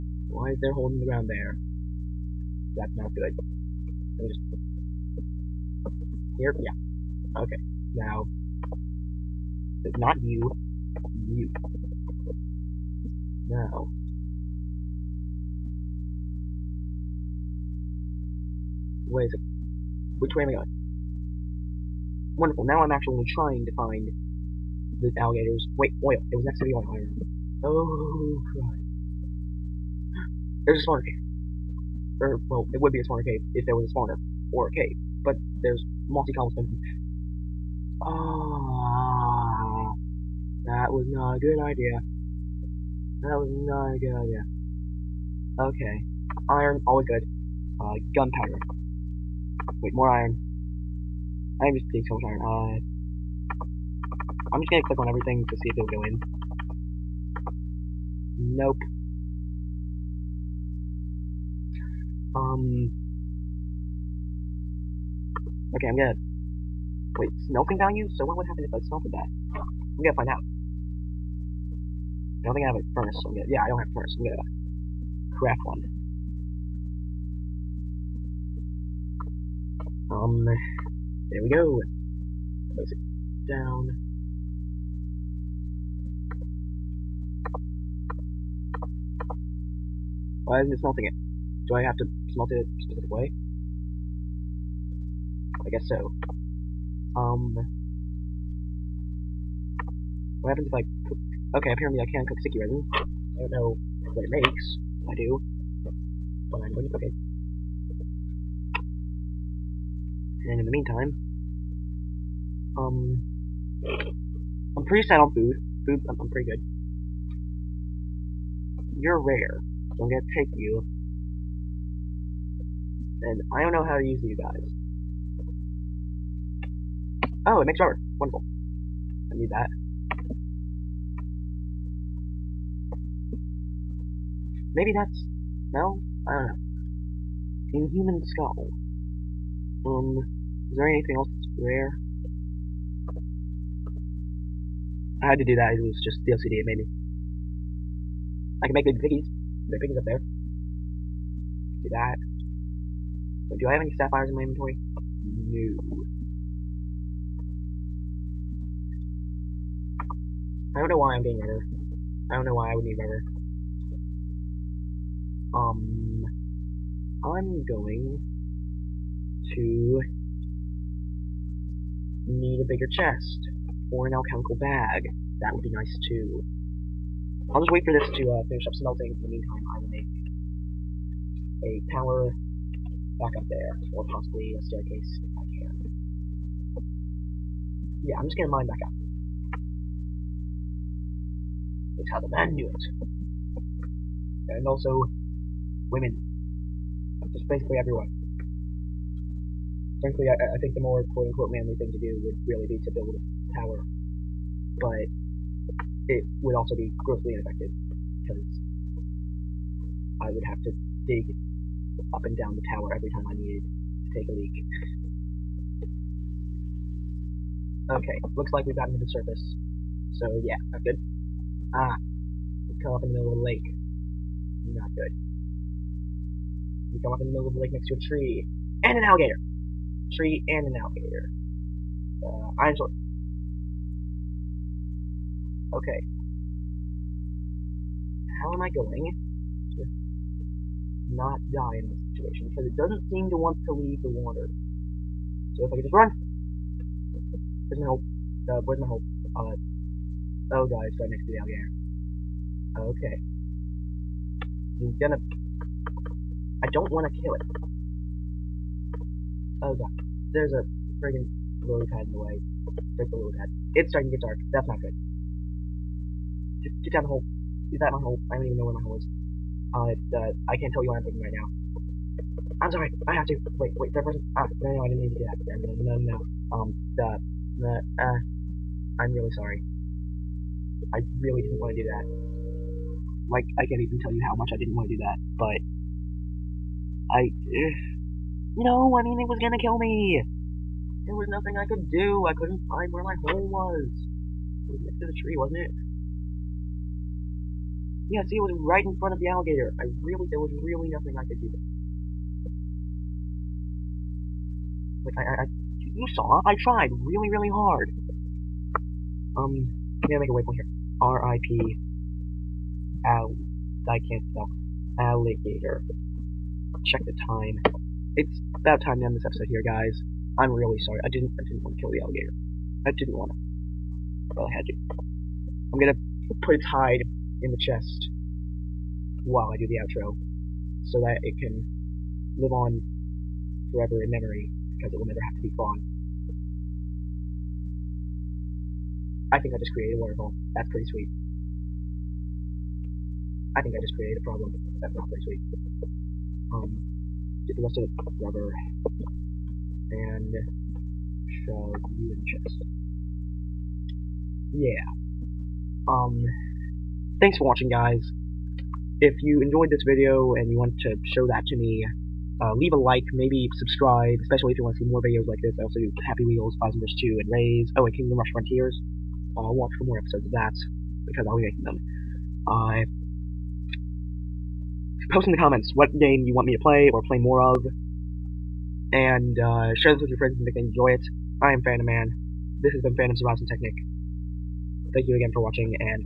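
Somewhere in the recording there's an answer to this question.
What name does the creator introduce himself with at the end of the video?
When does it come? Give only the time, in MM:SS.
06:21.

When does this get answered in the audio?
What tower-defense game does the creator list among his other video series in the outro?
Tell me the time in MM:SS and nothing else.
06:07.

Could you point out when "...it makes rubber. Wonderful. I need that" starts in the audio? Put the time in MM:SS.
02:07.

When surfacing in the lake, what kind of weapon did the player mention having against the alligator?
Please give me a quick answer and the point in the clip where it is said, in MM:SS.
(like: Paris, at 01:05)
Iron sword, at 03:52.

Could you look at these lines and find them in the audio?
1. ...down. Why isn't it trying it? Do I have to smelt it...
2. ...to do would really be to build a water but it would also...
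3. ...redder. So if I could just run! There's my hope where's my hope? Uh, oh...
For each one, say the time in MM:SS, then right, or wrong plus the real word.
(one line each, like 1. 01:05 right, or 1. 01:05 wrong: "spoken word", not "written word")
1. 01:23 wrong: "smelting", not "trying"
2. 03:21 wrong: "tower", not "water"
3. 04:04 wrong: "water", not "redder".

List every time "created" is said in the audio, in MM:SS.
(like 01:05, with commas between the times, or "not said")
05:39, 05:43.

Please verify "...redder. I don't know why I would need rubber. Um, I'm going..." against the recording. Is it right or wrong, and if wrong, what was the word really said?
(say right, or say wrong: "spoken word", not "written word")
right.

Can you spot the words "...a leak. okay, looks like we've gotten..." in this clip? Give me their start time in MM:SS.
03:34.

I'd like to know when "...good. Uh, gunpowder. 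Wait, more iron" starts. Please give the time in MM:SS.
00:47.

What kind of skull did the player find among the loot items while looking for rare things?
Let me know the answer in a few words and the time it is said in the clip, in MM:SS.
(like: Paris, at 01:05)
Inhuman skull, at 02:17.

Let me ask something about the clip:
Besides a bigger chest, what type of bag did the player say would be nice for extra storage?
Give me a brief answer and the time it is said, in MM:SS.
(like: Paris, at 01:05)
Alchemical bag, at 02:54.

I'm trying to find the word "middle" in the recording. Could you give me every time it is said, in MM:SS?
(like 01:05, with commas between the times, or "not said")
03:43, 03:47.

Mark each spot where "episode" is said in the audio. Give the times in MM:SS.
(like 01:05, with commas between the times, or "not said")
05:19, 06:09.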